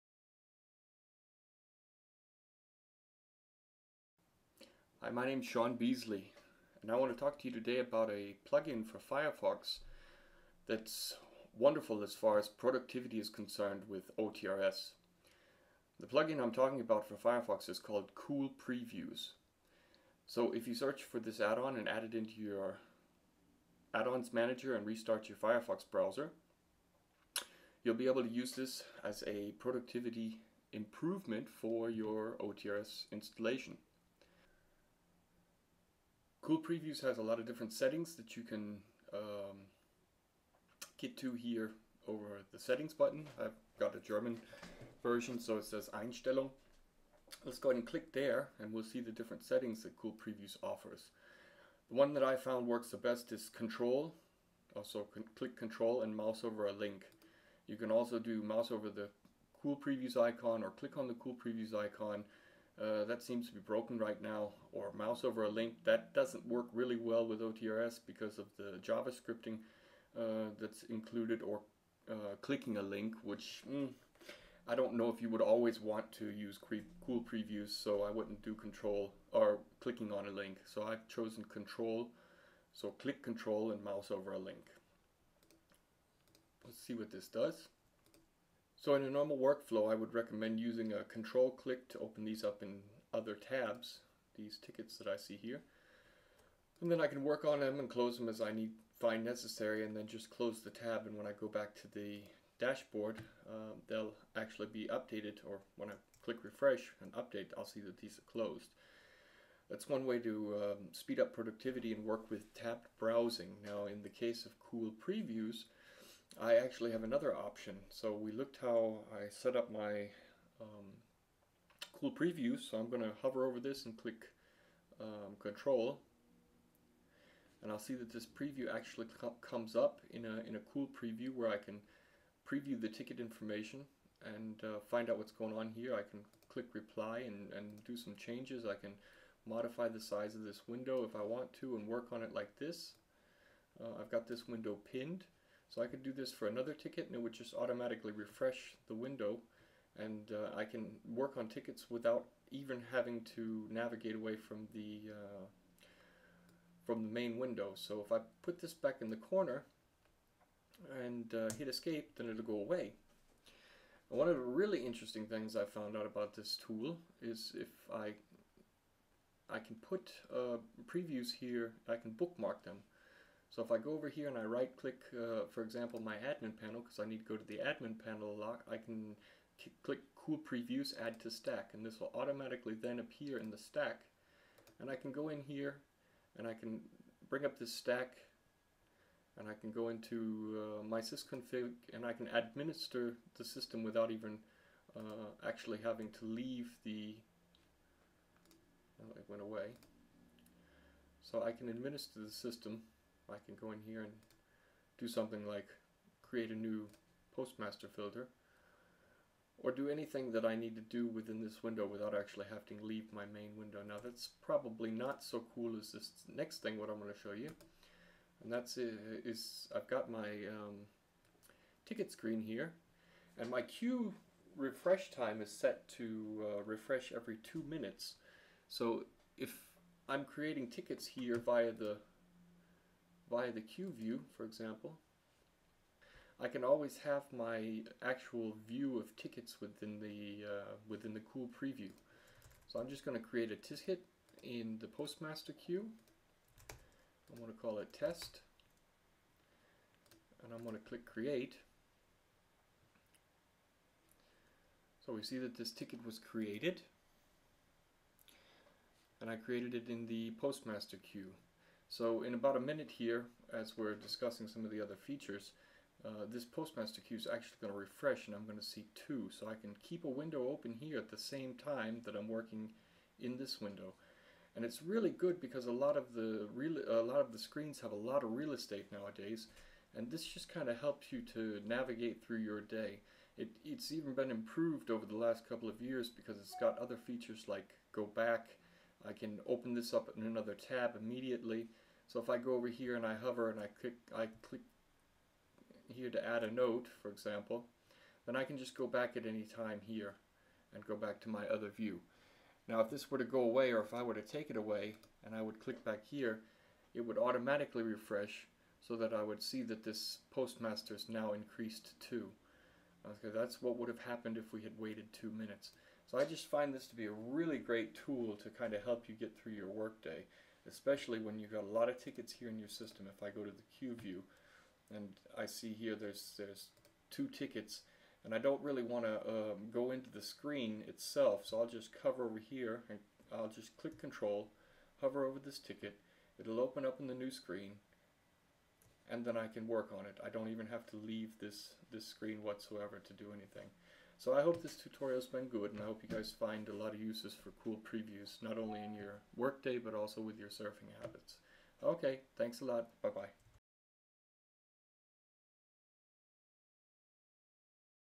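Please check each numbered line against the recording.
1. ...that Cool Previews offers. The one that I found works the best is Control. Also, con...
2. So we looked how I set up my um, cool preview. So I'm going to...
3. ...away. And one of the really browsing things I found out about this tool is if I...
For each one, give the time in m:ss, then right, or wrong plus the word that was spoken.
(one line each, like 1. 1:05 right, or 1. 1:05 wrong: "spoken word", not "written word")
1. 0:49 right
2. 1:57 right
3. 2:42 wrong: "interesting", not "browsing".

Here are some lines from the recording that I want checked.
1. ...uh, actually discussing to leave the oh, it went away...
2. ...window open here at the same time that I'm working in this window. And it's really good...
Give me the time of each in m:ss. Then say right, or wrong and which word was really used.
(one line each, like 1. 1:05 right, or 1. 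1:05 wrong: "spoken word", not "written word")
1. 3:14 wrong: "having", not "discussing"
2. 4:30 right.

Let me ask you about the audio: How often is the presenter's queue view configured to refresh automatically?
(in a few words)
every 2 minutes.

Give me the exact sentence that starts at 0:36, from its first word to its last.
Cool Previews has a lot of different settings that you can um, get to here over the settings button.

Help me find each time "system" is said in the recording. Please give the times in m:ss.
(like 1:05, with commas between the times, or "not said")
3:13, 3:22, 5:22.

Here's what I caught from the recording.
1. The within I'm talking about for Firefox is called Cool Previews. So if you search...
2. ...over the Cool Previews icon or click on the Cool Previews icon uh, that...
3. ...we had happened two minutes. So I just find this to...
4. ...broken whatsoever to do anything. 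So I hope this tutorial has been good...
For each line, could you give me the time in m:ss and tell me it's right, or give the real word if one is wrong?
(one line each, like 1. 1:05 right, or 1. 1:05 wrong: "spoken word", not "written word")
1. 0:15 wrong: "plugin", not "within"
2. 0:58 right
3. 5:14 wrong: "waited", not "happened"
4. 5:42 wrong: "screen", not "broken".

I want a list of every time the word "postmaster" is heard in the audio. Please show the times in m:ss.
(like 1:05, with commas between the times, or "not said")
3:27, 4:04, 4:20, 4:26, 5:10.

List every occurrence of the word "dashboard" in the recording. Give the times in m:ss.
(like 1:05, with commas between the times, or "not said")
1:42.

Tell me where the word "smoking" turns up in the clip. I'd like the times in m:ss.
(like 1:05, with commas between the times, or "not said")
not said.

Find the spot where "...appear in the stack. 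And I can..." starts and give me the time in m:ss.
3:02.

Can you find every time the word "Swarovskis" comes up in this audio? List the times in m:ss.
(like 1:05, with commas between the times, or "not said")
not said.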